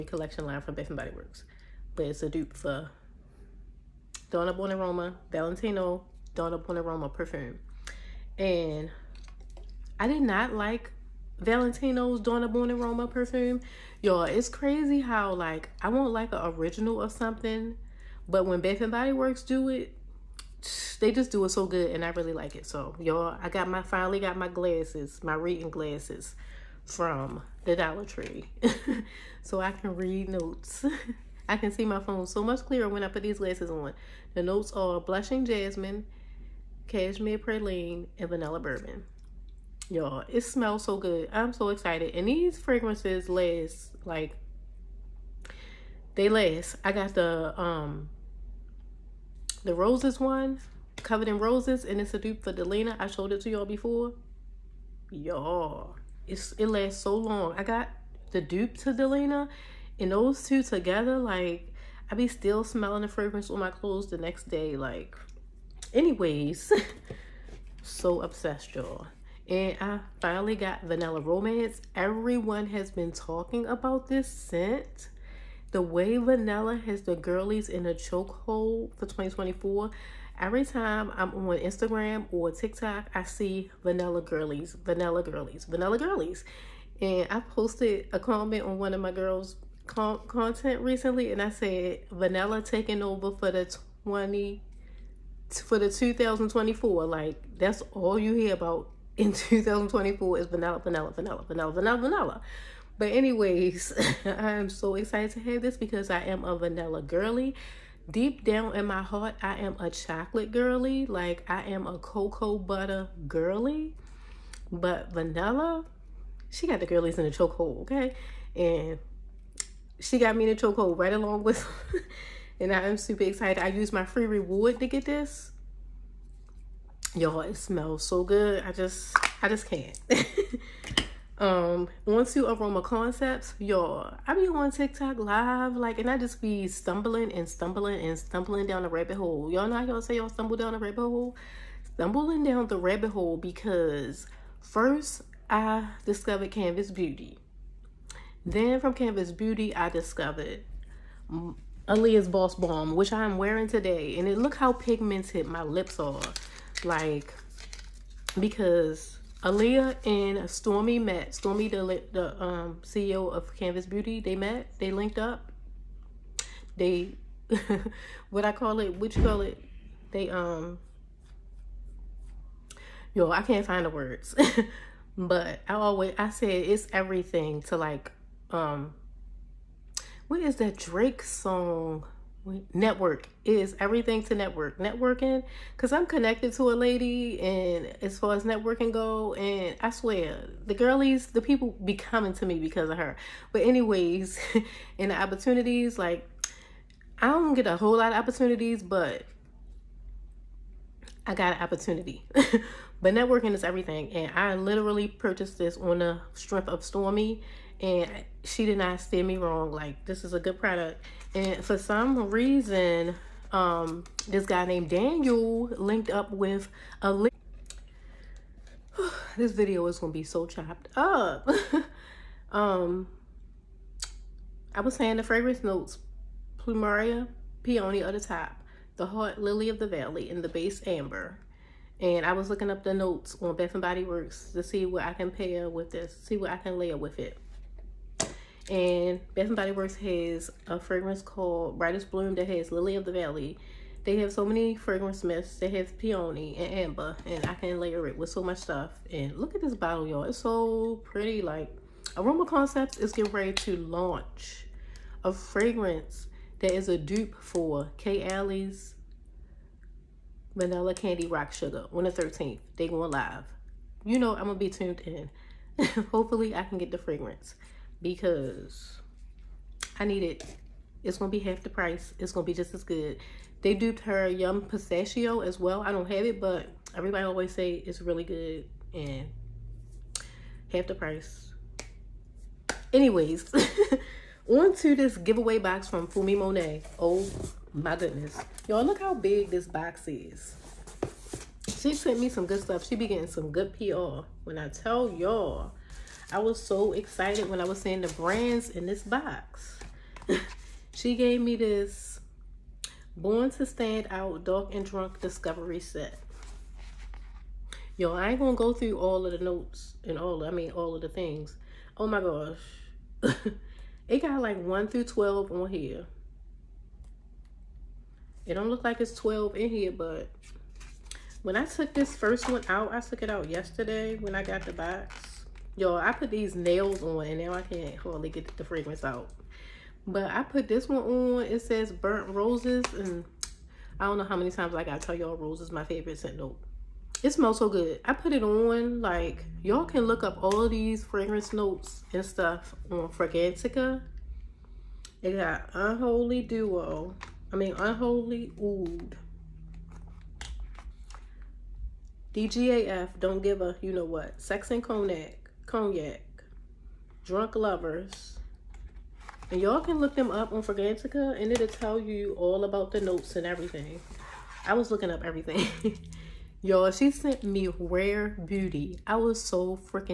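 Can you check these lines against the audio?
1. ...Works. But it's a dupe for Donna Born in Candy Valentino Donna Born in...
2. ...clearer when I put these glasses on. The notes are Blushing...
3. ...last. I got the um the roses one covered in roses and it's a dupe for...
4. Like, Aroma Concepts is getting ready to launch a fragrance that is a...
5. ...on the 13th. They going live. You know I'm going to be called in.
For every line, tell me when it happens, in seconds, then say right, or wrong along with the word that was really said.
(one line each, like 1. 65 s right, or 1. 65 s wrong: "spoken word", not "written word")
1. 1 s wrong: "Roma", not "Candy"
2. 32 s right
3. 46 s right
4. 251 s right
5. 261 s wrong: "tuned", not "called".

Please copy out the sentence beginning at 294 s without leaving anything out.
When I tell y'all, I was so excited when I was seeing the brands in this box.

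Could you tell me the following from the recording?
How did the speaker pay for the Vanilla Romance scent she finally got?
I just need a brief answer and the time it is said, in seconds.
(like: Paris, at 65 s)
free reward, at 124 s.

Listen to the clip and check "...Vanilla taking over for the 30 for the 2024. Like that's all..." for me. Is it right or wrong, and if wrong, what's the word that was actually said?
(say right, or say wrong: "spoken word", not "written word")
wrong: "20", not "30".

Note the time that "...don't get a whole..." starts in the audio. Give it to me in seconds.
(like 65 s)
197 s.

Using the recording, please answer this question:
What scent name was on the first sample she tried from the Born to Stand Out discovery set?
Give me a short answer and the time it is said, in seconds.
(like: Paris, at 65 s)
Burnt Roses, at 331 s.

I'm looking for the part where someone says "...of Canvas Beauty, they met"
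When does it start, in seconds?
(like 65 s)
163 s.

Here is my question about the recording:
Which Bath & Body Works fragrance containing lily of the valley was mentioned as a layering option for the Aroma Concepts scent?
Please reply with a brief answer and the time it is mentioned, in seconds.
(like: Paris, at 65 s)
Brightest Bloom, at 241 s.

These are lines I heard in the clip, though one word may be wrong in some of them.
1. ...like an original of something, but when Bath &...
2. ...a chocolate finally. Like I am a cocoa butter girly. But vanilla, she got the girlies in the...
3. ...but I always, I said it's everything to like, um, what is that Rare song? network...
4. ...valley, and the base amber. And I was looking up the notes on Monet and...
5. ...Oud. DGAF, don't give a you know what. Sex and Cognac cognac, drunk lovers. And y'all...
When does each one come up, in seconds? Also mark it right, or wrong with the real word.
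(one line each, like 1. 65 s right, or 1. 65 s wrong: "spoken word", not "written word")
1. 16 s right
2. 109 s wrong: "girly", not "finally"
3. 175 s wrong: "Drake", not "Rare"
4. 229 s wrong: "Bath", not "Monet"
5. 348 s right.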